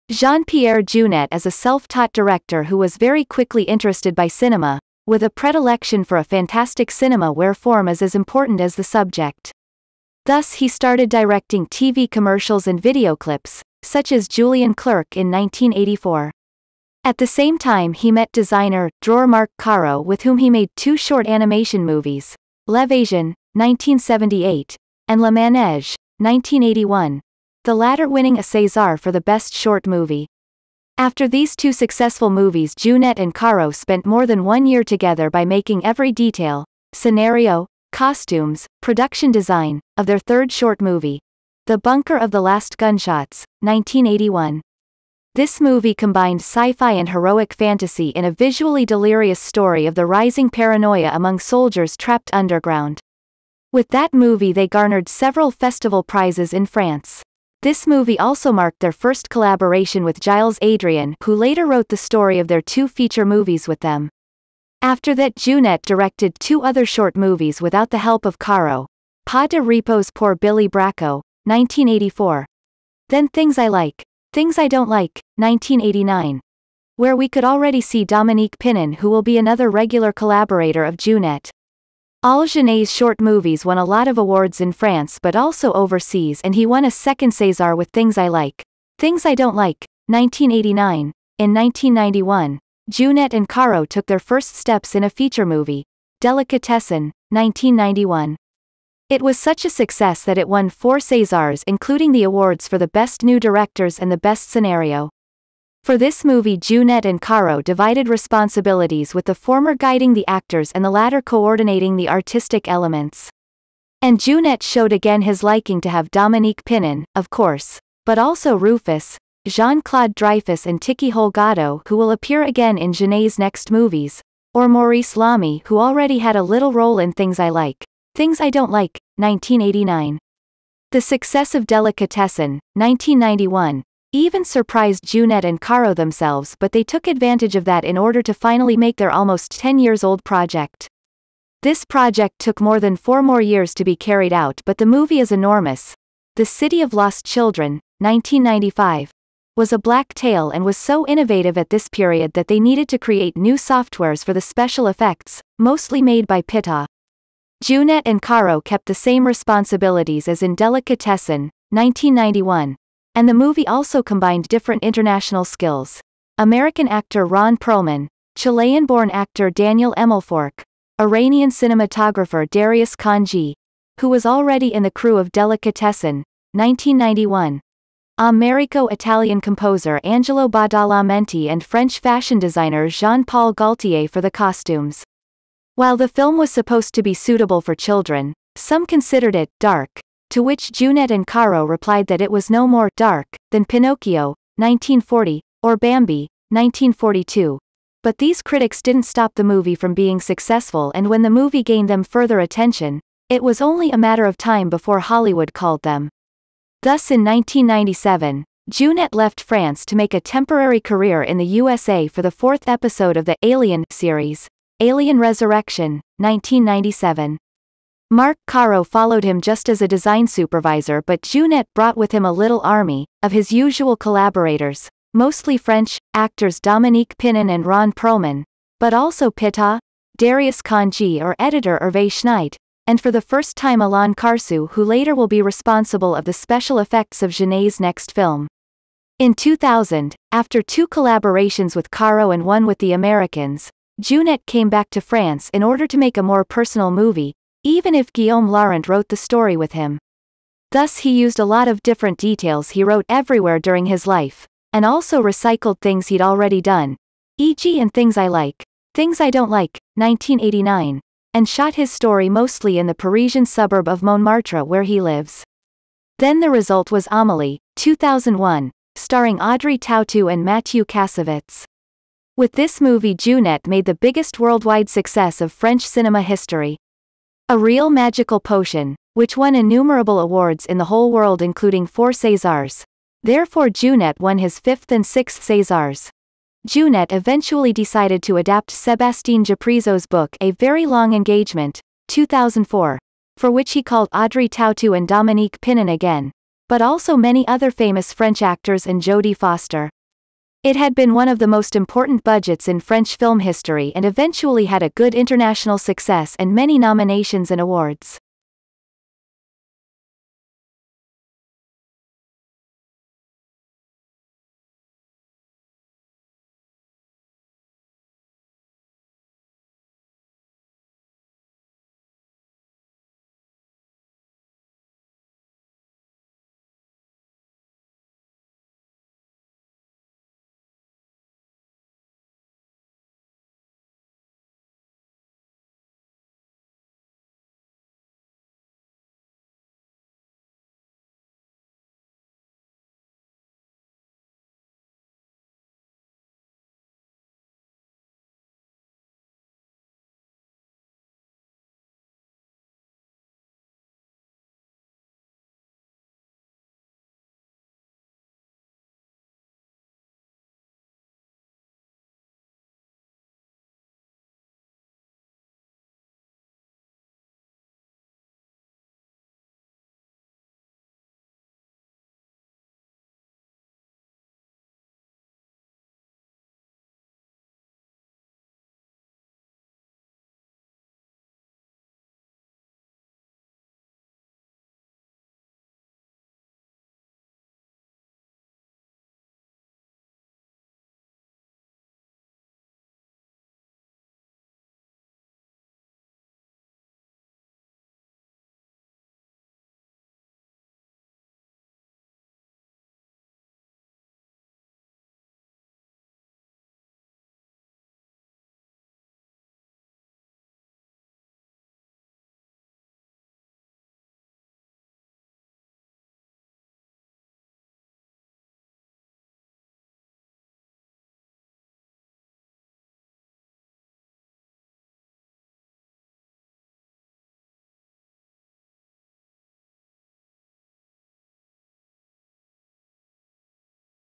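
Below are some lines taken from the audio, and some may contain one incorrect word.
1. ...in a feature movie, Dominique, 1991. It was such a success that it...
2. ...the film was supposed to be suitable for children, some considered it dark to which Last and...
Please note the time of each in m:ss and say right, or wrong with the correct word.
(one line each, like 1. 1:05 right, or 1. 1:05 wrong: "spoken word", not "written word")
1. 1:34 wrong: "Delicatessen", not "Dominique"
2. 3:05 wrong: "Jeunet", not "Last".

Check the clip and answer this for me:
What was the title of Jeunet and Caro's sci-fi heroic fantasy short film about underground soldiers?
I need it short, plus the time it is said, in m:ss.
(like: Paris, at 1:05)
The Bunker of the Last Gunshots, at 0:41.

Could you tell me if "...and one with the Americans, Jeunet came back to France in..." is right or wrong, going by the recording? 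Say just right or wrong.
right.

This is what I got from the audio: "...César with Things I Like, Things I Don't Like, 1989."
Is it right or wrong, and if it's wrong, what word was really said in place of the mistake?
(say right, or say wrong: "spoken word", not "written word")
right.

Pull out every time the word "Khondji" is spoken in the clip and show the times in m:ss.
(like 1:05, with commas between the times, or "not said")
2:52, 3:50.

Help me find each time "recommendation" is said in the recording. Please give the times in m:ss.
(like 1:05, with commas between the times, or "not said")
not said.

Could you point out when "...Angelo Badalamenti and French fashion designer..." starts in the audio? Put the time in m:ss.
3:00.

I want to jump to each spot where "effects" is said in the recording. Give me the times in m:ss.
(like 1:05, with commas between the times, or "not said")
2:34, 3:56.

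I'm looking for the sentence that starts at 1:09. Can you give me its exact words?
Pas de repos pour Billy Brakko, 1984.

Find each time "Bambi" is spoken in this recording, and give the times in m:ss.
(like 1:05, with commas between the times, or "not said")
3:15.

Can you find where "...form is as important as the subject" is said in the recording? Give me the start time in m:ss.
0:07.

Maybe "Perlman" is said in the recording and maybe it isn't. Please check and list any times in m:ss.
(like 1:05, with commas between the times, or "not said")
2:47, 3:47.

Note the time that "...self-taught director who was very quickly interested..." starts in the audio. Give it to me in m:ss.
0:01.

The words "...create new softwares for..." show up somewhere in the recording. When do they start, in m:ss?
2:32.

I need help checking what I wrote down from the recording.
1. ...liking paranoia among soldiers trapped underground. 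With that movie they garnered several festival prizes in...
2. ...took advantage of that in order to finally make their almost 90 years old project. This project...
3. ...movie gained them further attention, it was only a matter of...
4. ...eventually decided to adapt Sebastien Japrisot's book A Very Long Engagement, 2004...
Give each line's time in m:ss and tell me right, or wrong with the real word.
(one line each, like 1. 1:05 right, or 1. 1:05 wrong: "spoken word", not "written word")
1. 0:50 wrong: "rising", not "liking"
2. 2:16 wrong: "10", not "90"
3. 3:21 right
4. 4:47 right.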